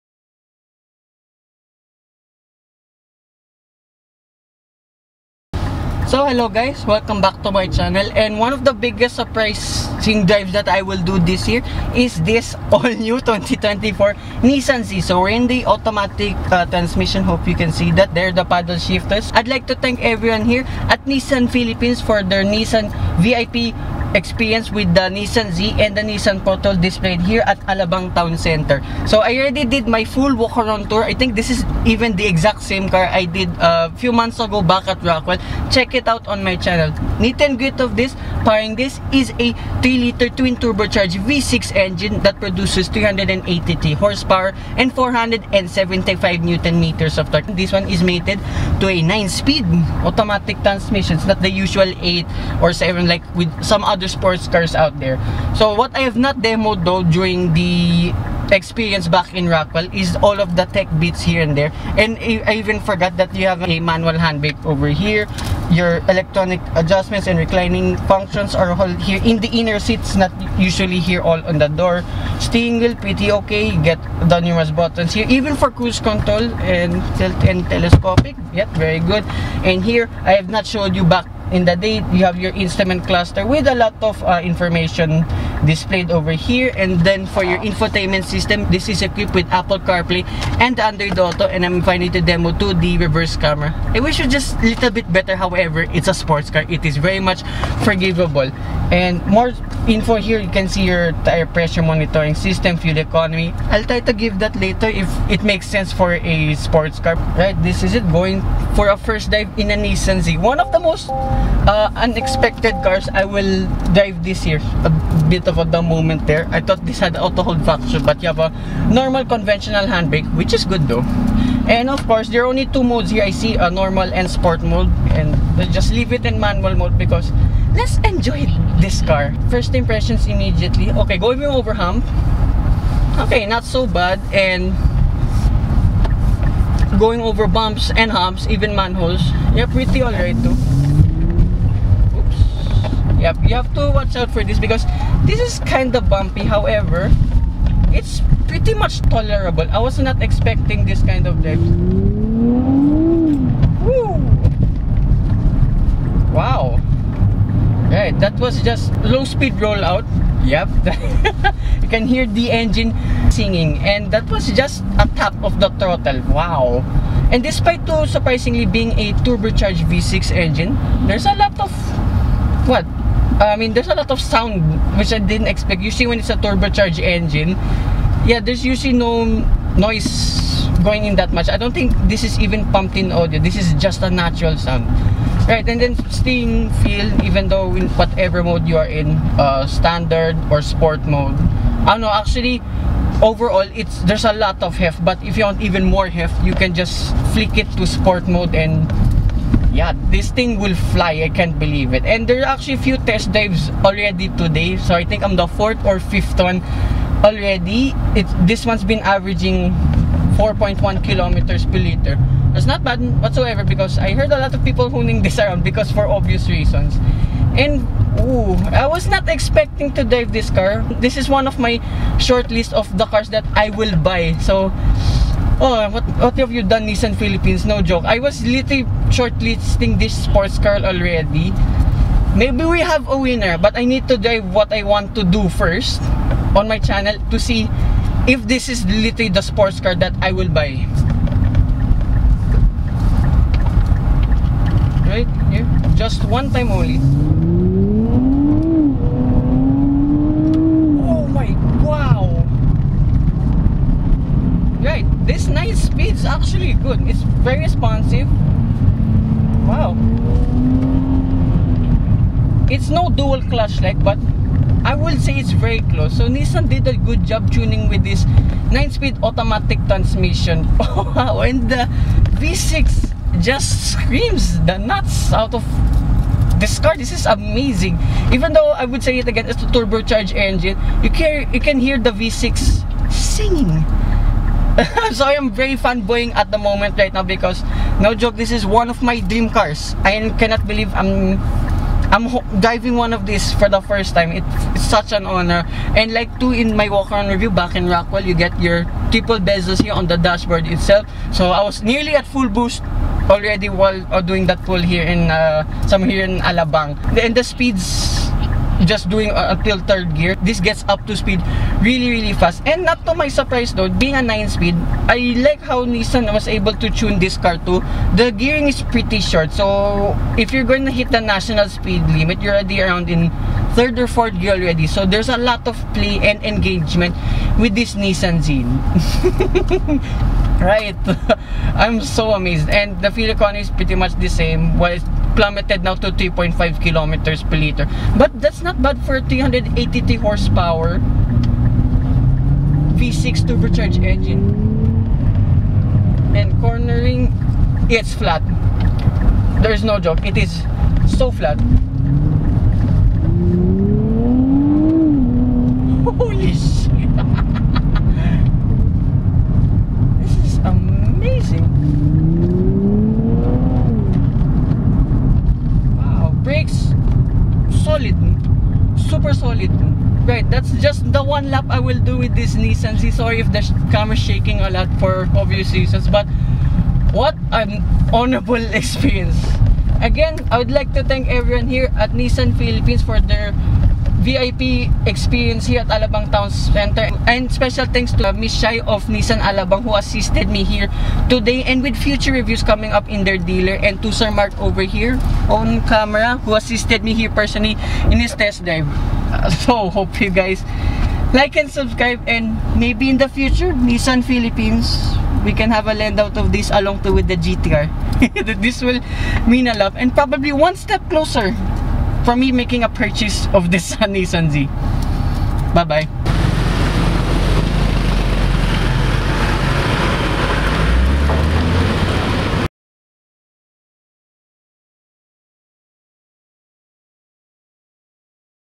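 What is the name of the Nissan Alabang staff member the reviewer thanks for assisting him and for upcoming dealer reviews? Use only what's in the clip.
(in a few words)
Shai.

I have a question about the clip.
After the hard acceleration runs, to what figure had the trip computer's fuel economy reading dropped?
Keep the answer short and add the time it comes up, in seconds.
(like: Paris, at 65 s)
3.5 km/L, at 336 s.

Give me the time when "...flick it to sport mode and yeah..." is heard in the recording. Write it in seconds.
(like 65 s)
197 s.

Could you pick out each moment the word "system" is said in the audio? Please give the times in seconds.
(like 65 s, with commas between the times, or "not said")
88 s, 102 s.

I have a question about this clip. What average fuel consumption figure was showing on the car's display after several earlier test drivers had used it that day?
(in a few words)
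4.1 km/L.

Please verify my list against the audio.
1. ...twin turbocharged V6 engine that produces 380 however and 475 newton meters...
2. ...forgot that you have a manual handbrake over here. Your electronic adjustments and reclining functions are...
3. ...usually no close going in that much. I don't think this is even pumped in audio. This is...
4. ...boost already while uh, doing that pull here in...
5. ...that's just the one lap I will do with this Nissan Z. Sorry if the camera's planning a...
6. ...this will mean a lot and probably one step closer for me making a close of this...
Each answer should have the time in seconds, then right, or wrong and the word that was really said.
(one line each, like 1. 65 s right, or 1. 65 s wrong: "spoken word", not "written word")
1. 40 s wrong: "horsepower", not "however"
2. 62 s right
3. 178 s wrong: "noise", not "close"
4. 302 s right
5. 370 s wrong: "shaking", not "planning"
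6. 408 s wrong: "purchase", not "close".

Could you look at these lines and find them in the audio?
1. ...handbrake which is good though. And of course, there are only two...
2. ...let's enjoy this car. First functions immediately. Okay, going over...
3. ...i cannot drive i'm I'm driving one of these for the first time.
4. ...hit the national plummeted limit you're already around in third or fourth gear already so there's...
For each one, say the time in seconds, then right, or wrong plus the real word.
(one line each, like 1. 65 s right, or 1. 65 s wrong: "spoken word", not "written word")
1. 119 s right
2. 127 s wrong: "impressions", not "functions"
3. 290 s wrong: "believe", not "drive"
4. 320 s wrong: "speed", not "plummeted".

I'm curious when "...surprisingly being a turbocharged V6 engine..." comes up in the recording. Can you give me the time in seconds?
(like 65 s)
168 s.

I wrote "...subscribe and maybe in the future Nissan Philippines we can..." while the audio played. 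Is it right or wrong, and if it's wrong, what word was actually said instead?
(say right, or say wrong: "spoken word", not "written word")
right.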